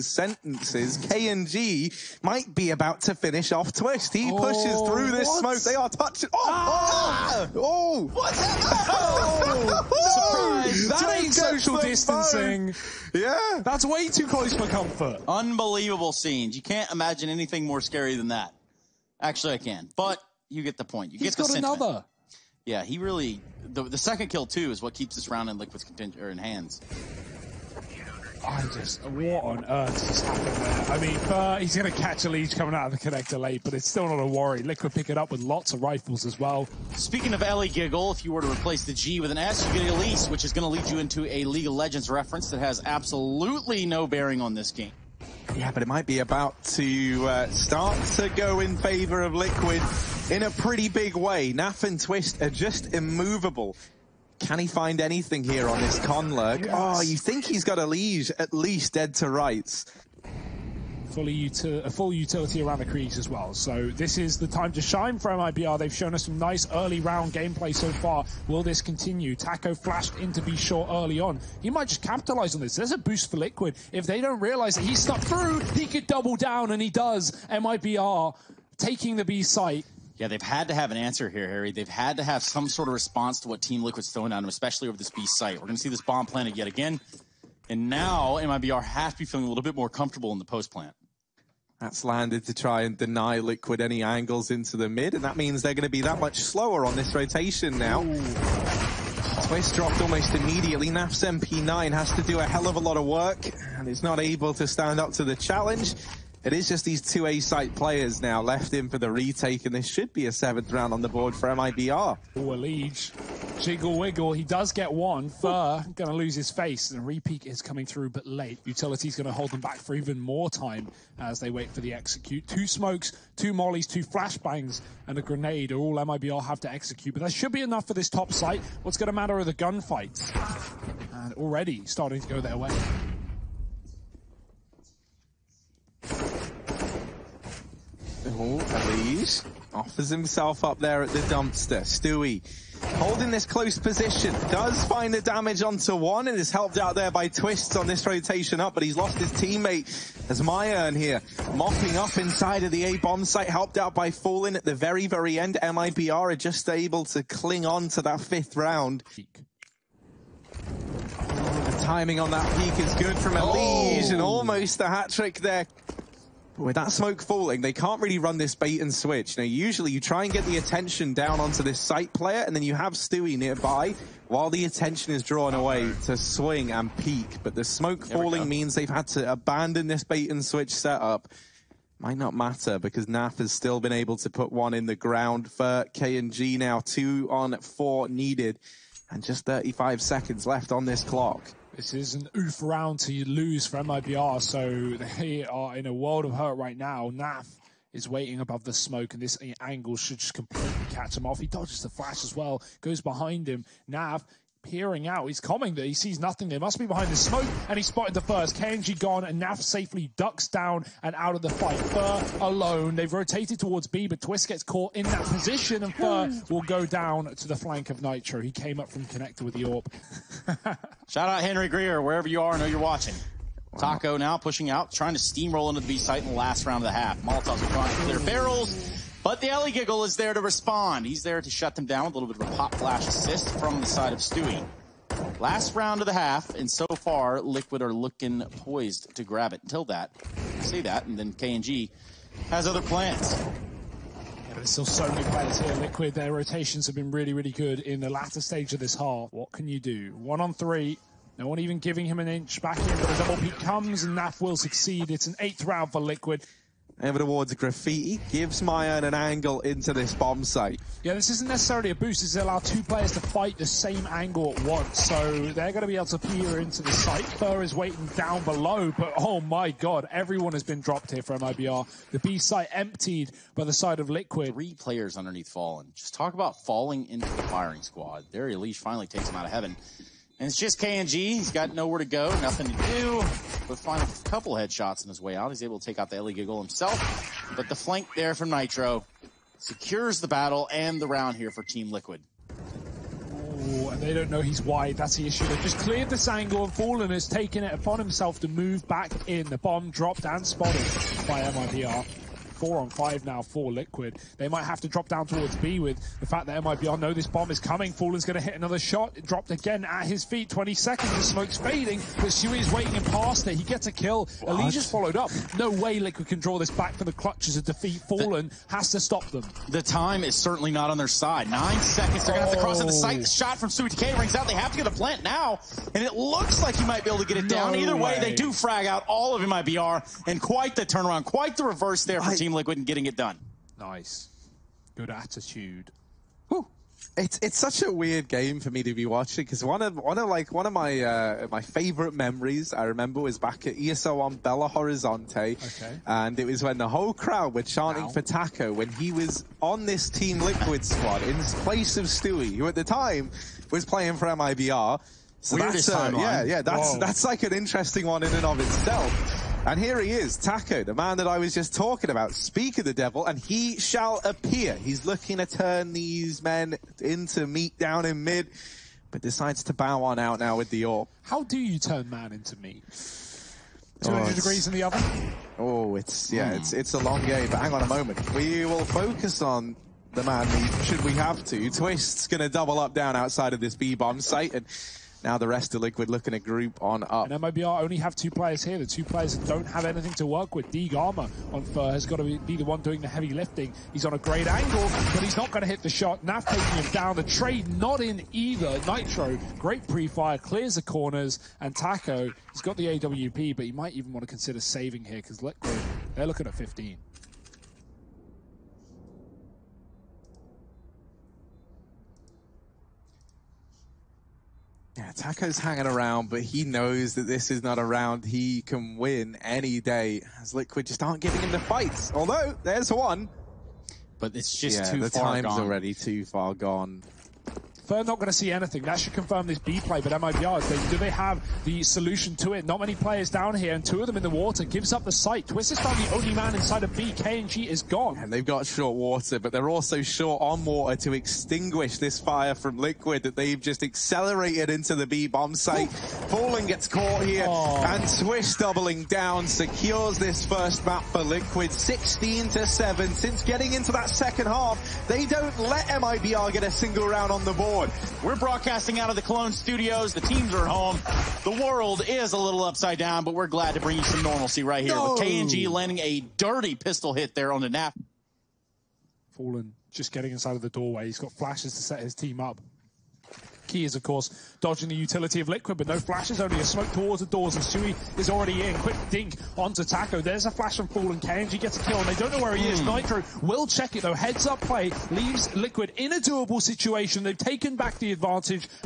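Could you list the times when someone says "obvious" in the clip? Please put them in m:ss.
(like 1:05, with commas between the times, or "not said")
not said.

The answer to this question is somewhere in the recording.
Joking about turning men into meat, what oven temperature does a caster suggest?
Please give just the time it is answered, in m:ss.
6:14.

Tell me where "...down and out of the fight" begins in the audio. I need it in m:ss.
3:30.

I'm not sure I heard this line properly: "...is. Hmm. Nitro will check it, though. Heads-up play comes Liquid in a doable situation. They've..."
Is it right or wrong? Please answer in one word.
wrong.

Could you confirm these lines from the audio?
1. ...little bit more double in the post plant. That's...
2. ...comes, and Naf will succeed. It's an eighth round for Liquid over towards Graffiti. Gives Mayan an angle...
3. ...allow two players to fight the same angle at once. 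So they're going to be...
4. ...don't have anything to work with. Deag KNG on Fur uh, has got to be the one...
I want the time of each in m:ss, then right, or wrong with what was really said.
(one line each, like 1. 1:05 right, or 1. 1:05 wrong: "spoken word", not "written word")
1. 1:29 wrong: "comfortable", not "double"
2. 4:13 right
3. 4:22 right
4. 6:29 wrong: "Armor", not "KNG".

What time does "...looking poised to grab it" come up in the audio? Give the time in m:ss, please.
3:57.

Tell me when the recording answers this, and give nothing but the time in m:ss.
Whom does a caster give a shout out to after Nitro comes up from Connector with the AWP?
3:41.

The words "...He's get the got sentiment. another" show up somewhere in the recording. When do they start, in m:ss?
0:21.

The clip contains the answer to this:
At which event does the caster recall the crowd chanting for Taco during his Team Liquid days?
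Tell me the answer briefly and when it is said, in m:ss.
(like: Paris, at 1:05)
ESO on Belo Horizonte, at 5:43.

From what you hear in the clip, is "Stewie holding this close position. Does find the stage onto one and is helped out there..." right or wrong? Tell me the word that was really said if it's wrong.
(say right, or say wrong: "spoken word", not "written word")
wrong: "damage", not "stage".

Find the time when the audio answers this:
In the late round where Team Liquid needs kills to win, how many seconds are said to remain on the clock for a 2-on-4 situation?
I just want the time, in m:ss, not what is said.
3:09.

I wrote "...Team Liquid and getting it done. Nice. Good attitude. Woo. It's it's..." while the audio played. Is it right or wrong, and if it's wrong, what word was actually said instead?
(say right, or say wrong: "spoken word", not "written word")
right.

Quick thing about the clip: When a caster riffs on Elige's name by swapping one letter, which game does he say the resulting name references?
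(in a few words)
League of Legends.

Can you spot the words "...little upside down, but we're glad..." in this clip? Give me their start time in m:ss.
7:42.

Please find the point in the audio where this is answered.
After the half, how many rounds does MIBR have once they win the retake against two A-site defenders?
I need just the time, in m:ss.
1:50.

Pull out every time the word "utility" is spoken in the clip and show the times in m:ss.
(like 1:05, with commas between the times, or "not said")
1:02, 1:58, 7:54.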